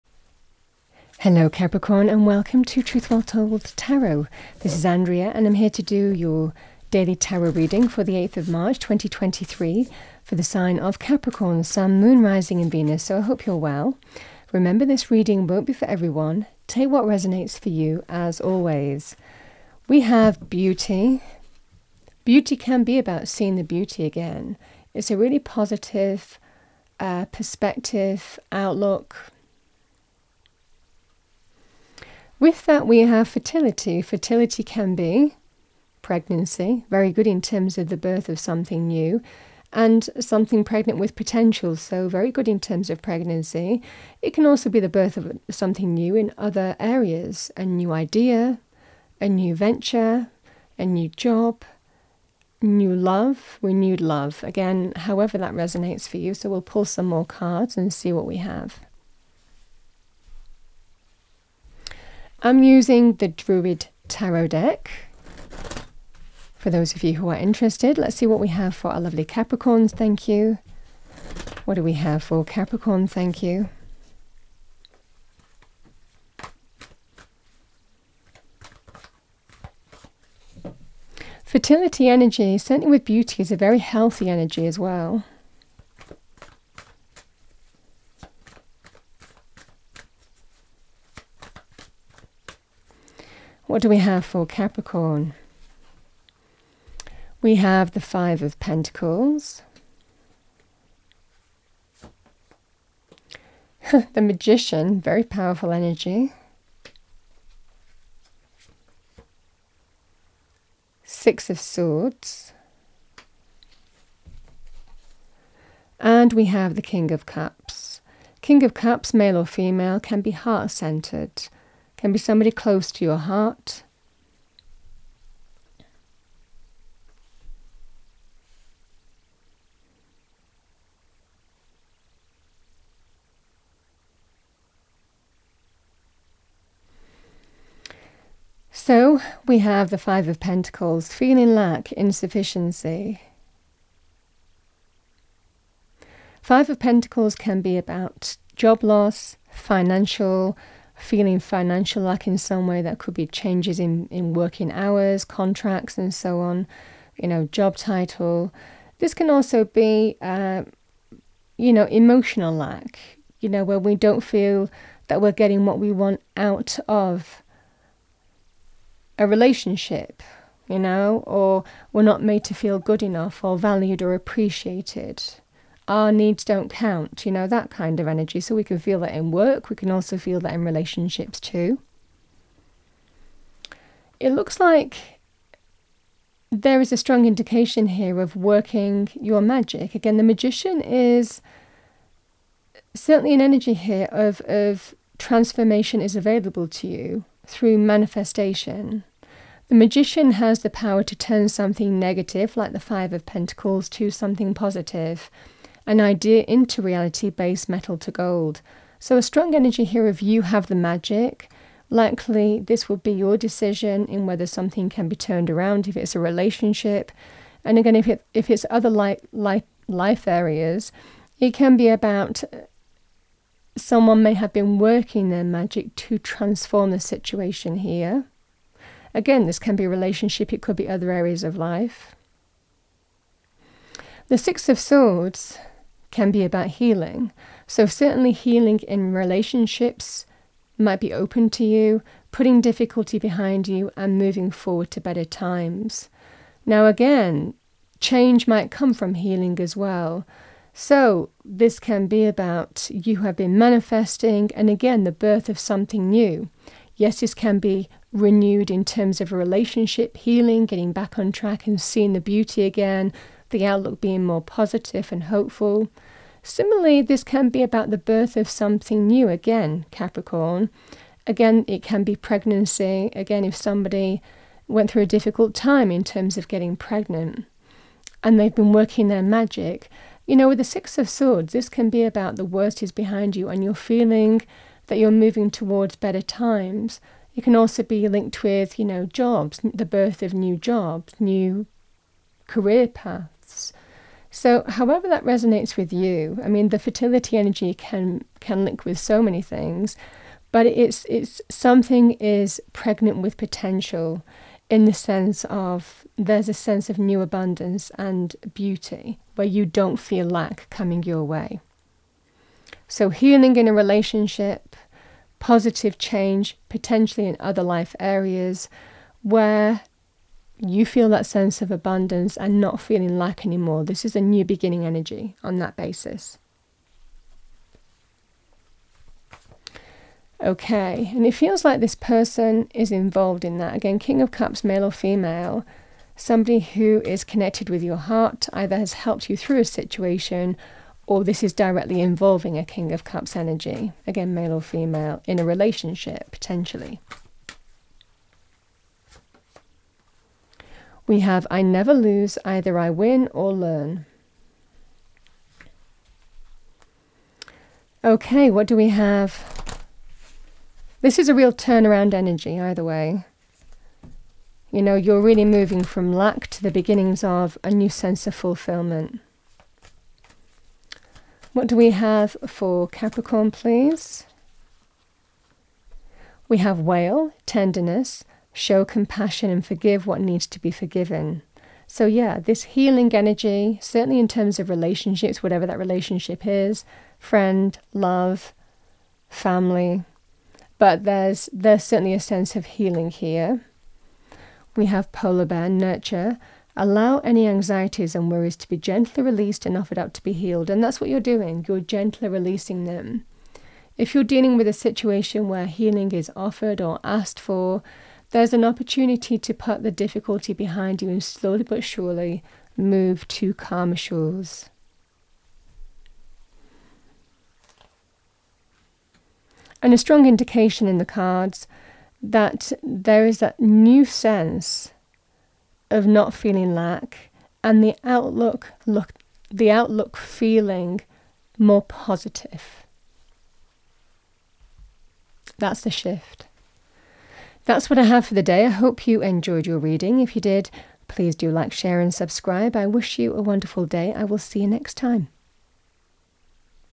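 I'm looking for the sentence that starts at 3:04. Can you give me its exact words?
It looks like there is a strong indication here of working your magic.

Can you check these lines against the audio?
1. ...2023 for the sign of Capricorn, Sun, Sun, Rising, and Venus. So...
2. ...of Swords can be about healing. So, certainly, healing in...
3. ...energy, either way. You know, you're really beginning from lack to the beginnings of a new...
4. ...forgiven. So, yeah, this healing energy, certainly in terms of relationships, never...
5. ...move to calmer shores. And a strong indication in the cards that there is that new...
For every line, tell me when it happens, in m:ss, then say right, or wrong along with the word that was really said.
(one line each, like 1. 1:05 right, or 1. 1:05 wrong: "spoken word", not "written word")
1. 0:08 wrong: "Moon", not "Sun"
2. 3:54 right
3. 6:02 wrong: "moving", not "beginning"
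4. 6:20 wrong: "whatever", not "never"
5. 6:52 right.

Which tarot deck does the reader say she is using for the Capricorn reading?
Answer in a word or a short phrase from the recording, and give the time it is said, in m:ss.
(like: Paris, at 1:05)
Druid Tarot, at 1:03.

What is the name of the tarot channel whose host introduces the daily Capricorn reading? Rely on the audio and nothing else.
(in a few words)
Truth Well Told Tarot.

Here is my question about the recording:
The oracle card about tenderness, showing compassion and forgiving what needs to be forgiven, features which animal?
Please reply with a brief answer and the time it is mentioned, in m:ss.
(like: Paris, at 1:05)
Whale, at 6:16.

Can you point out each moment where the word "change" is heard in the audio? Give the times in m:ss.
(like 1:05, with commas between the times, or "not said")
2:33, 4:07, 5:15.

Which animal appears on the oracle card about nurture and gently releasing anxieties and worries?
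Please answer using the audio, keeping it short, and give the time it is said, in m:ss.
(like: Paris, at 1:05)
Polar bear, at 6:35.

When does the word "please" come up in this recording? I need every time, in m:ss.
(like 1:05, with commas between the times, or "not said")
6:13, 7:21.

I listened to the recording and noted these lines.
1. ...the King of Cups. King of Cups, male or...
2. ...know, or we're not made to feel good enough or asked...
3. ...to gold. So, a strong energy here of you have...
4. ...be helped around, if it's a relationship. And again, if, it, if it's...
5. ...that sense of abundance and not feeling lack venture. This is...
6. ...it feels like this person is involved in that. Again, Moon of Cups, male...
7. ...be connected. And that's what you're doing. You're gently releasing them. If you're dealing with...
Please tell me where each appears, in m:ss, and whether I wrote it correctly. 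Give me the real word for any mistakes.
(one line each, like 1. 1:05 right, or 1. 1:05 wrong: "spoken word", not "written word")
1. 1:56 right
2. 2:50 wrong: "valued", not "asked"
3. 3:27 right
4. 3:35 wrong: "turned", not "helped"
5. 5:21 wrong: "anymore", not "venture"
6. 5:31 wrong: "King", not "Moon"
7. 6:40 wrong: "healed", not "connected".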